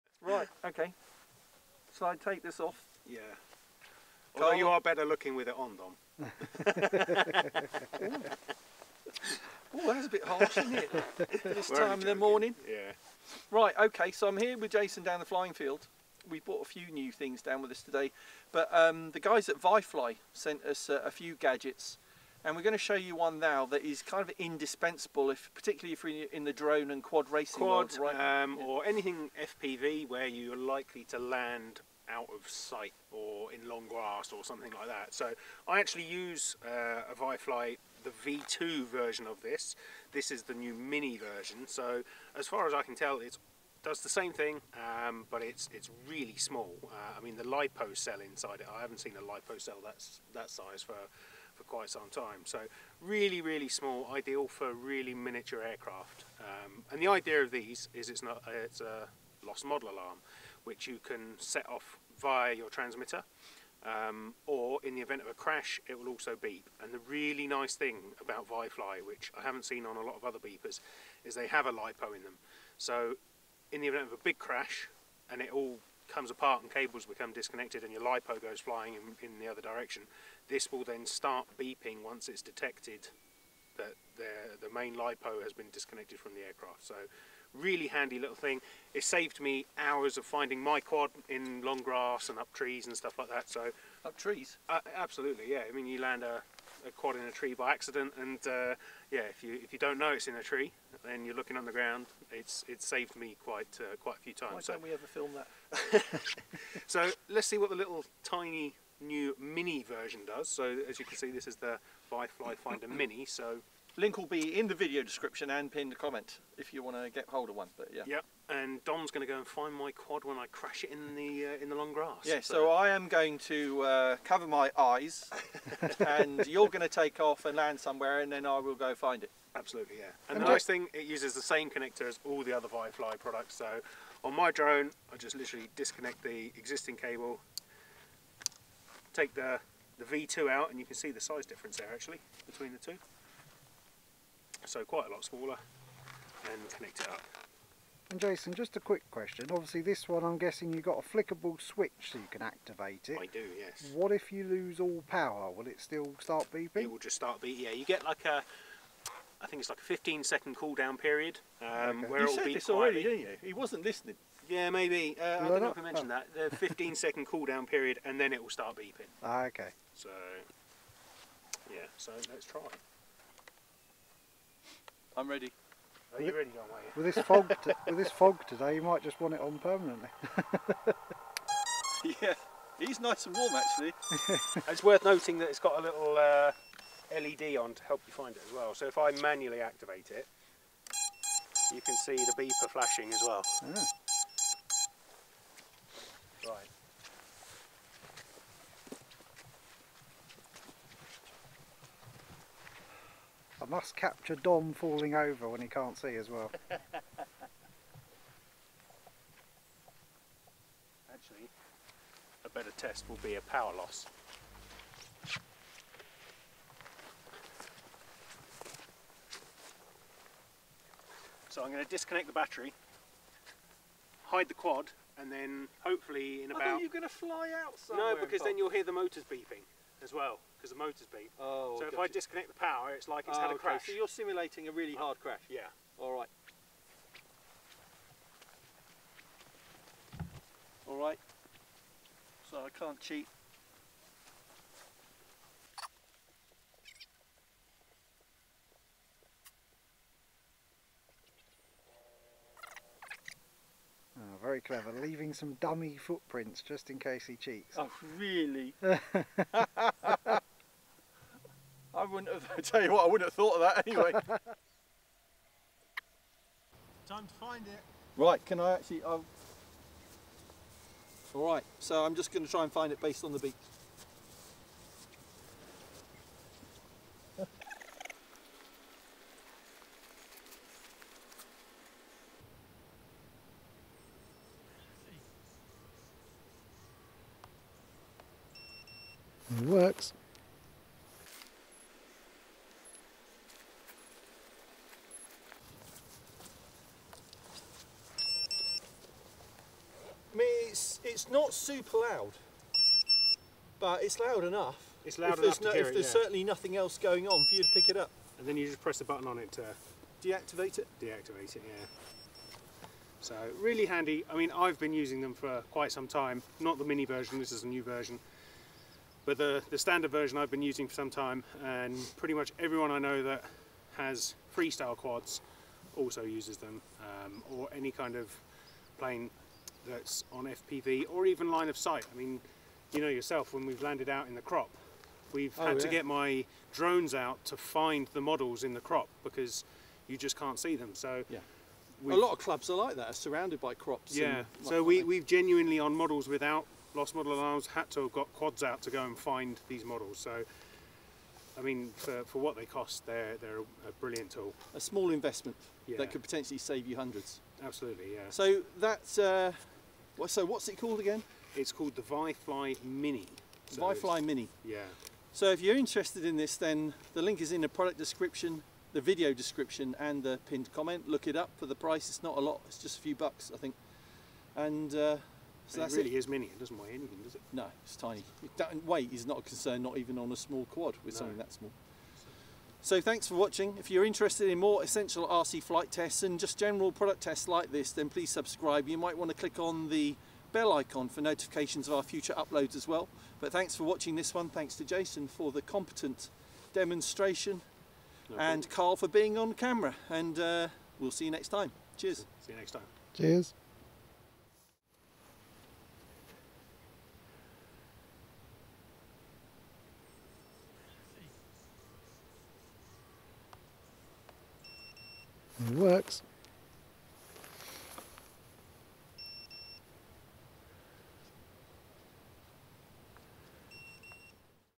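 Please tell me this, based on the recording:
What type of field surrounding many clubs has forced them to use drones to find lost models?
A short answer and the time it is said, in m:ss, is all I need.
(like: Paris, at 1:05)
crops, at 5:43.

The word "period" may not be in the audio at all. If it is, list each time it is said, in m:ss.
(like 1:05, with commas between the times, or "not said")
2:40, 2:47.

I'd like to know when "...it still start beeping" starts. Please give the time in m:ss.
2:35.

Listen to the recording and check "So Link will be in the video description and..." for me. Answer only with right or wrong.
right.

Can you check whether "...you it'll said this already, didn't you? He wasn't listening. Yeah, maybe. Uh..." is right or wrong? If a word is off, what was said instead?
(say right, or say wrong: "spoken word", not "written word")
right.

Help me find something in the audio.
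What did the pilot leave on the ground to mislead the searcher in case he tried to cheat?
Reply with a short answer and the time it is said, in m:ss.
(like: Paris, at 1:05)
dummy footprints, at 4:15.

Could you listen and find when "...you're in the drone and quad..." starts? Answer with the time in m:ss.
0:26.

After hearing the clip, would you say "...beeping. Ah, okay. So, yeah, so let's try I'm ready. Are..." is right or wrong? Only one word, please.
right.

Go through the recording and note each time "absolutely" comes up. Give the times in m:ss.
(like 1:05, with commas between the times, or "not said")
1:34, 2:09, 5:57.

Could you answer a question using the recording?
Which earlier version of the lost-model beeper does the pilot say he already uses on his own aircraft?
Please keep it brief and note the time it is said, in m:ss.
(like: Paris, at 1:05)
V2, at 0:38.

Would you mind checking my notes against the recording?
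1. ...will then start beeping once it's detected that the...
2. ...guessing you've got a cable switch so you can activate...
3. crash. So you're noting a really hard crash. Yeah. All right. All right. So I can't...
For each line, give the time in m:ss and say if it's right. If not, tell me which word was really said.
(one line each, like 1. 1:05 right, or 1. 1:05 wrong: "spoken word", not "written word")
1. 1:20 right
2. 2:30 wrong: "flickable", not "cable"
3. 3:53 wrong: "simulating", not "noting".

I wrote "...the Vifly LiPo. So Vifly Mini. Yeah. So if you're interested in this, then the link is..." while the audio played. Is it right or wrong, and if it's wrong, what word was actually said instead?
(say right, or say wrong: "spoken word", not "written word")
wrong: "Mini", not "LiPo".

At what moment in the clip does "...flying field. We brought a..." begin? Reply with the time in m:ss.
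0:15.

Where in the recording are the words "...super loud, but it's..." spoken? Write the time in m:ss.
5:01.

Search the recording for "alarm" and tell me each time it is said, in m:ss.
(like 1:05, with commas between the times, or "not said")
0:59, 5:47.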